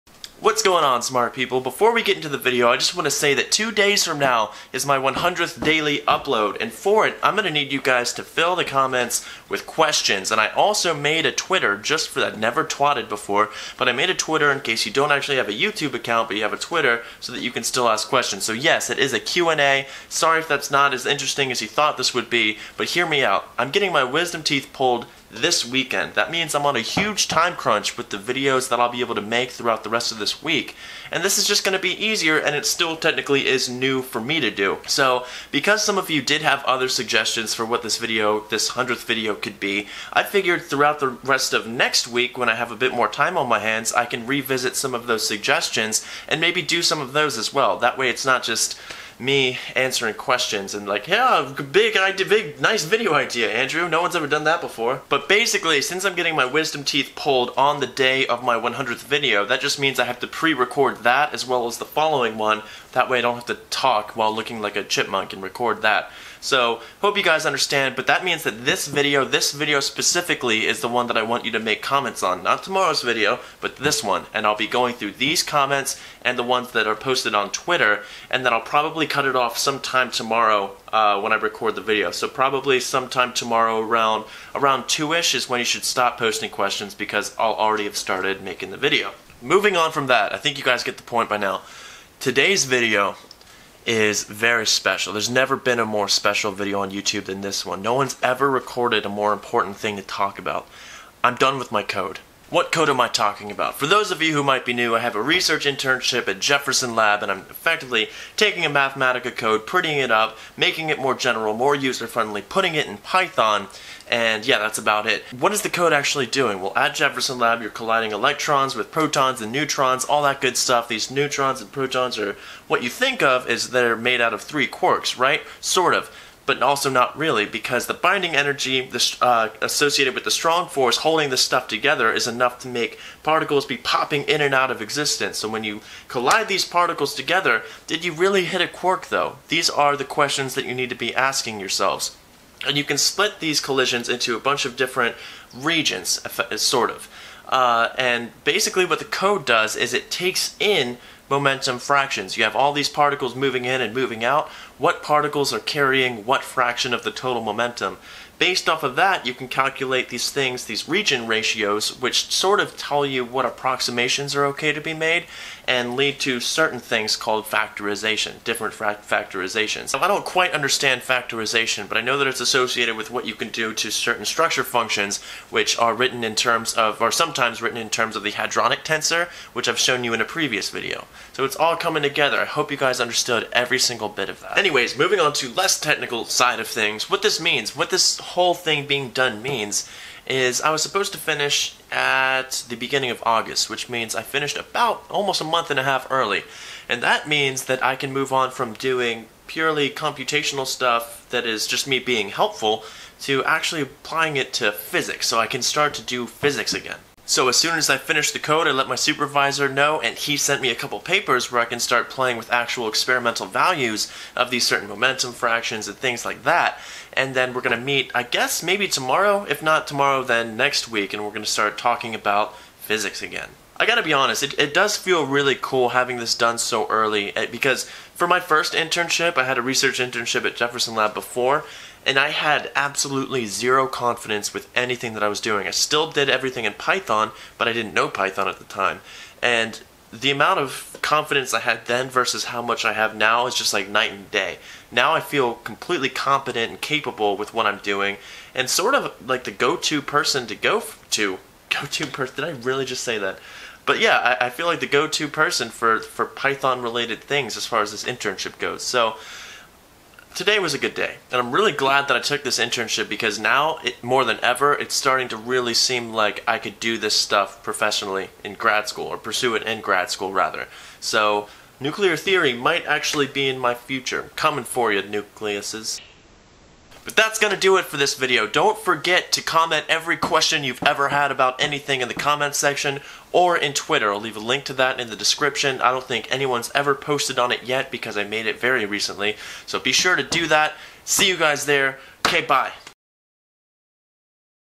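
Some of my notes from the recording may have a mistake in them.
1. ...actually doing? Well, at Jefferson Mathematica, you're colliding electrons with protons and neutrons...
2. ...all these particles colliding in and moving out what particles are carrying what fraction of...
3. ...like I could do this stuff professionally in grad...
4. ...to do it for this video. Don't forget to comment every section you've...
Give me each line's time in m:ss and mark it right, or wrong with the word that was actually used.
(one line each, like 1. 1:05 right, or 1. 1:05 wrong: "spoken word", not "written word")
1. 1:55 wrong: "Lab", not "Mathematica"
2. 2:32 wrong: "moving", not "colliding"
3. 4:26 right
4. 4:37 wrong: "question", not "section".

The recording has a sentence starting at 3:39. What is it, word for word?
If not tomorrow, then next week, and we're going to start talking about physics again.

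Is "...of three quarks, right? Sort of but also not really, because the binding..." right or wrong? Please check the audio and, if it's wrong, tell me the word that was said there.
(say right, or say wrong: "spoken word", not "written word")
right.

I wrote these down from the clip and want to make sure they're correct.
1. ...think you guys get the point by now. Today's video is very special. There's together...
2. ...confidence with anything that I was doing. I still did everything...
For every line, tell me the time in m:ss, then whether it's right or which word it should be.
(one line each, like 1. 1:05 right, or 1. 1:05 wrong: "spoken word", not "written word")
1. 1:30 wrong: "never", not "together"
2. 3:53 right.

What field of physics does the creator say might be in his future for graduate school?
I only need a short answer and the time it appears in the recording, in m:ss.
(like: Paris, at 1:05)
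Nuclear theory, at 4:31.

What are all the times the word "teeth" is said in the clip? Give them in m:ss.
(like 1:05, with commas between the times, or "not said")
0:24, 0:56.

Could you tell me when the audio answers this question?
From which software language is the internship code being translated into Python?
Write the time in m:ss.
1:48.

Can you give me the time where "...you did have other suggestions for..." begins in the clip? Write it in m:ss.
0:36.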